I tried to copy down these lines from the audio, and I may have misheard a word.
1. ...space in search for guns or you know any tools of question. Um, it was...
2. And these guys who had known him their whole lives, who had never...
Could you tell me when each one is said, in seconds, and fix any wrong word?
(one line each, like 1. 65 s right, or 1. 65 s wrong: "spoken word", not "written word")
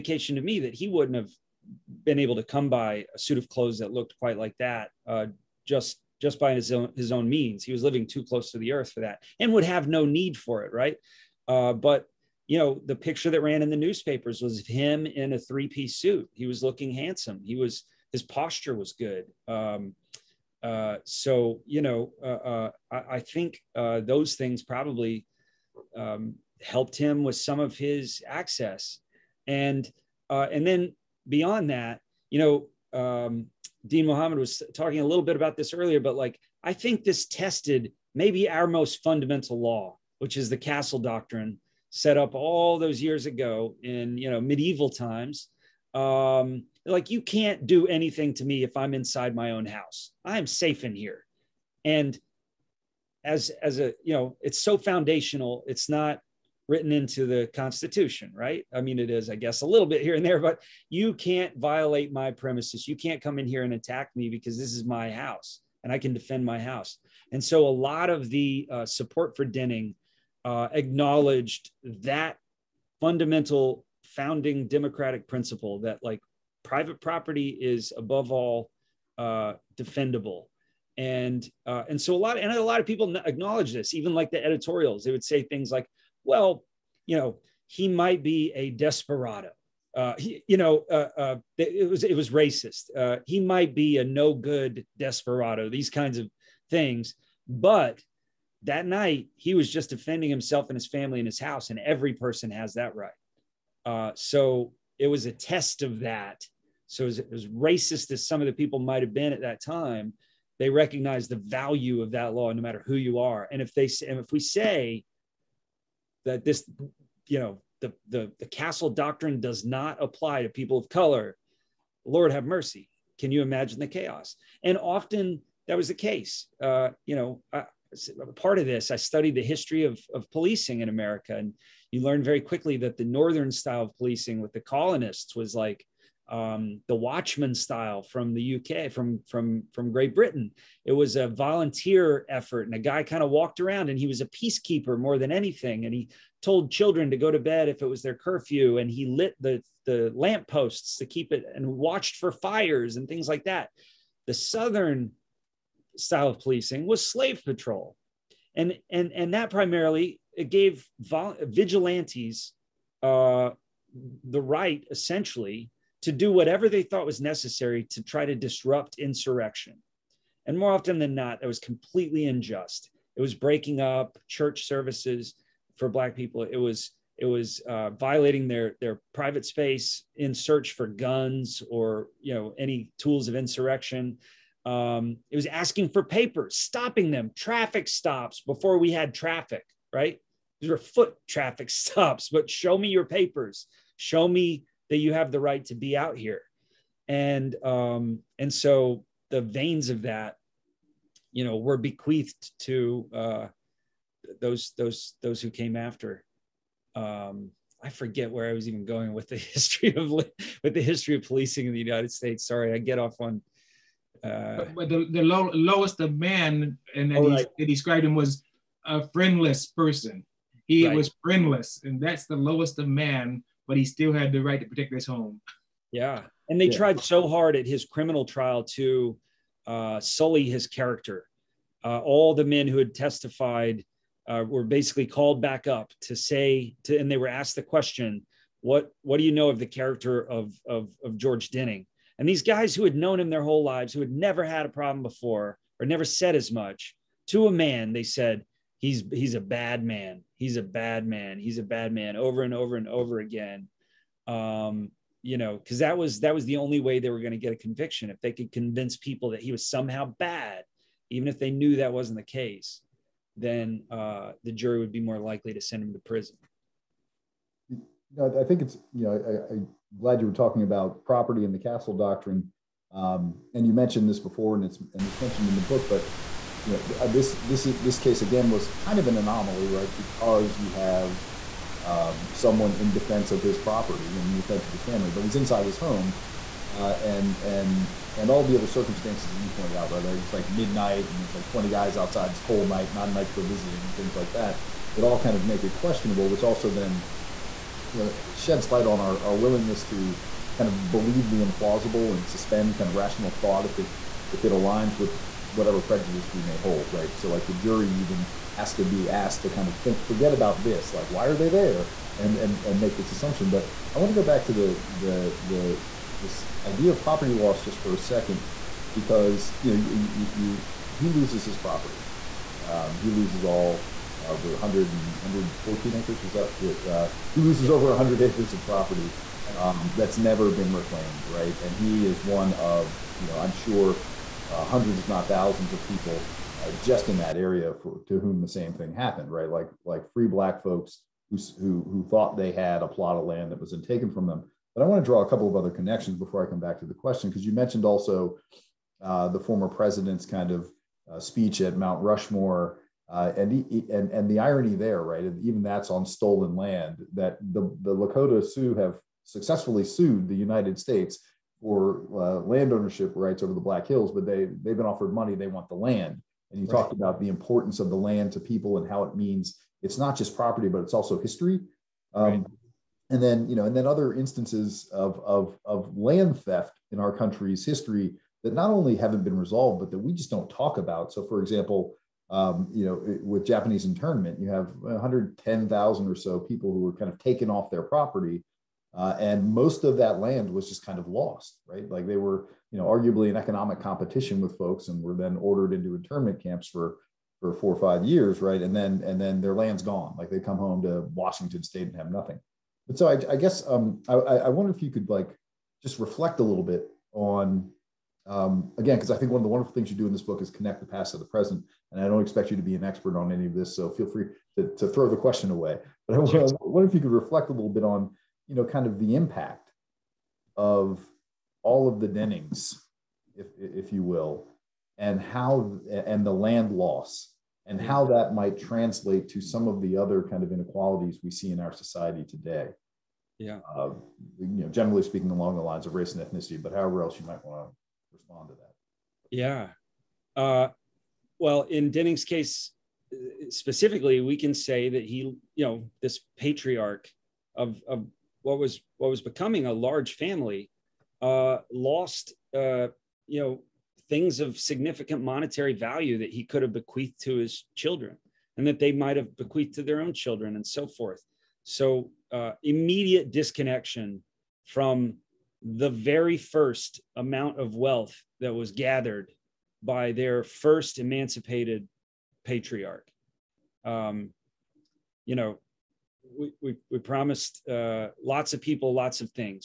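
1. 179 s wrong: "insurrection", not "question"
2. 242 s right.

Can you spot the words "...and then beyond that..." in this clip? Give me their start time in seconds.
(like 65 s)
30 s.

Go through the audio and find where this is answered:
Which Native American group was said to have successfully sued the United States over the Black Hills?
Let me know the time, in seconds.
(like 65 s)
357 s.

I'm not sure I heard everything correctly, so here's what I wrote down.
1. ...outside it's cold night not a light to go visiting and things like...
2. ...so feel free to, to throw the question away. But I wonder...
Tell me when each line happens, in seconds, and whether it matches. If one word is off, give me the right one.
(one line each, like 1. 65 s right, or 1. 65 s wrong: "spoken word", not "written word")
1. 291 s wrong: "night", not "light"
2. 413 s right.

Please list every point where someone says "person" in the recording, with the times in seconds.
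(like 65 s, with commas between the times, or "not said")
102 s, 219 s.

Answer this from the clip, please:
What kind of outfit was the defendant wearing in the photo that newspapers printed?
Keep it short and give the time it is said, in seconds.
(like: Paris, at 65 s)
three piece suit, at 15 s.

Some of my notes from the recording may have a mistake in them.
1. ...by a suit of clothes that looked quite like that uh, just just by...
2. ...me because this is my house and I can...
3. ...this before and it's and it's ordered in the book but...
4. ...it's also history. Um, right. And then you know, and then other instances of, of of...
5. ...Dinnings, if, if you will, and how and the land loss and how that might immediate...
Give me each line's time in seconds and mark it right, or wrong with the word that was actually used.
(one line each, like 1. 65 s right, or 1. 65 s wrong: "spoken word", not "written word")
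1. 2 s right
2. 64 s right
3. 274 s wrong: "mentioned", not "ordered"
4. 370 s right
5. 422 s wrong: "translate", not "immediate".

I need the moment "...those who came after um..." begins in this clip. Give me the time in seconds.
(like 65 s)
205 s.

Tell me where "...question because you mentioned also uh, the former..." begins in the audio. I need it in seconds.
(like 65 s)
346 s.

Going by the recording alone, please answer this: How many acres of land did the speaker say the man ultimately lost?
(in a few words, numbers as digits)
114.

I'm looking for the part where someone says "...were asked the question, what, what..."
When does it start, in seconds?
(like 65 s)
237 s.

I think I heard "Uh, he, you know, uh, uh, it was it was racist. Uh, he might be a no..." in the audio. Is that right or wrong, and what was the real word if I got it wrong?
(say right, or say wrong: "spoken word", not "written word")
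right.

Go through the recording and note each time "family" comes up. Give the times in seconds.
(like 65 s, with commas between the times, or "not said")
100 s, 284 s, 450 s.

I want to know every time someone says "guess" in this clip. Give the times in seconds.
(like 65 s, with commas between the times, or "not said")
59 s, 403 s.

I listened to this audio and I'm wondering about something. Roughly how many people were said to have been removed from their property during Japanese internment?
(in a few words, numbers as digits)
110,000.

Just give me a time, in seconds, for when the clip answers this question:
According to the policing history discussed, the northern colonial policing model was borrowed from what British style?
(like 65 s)
136 s.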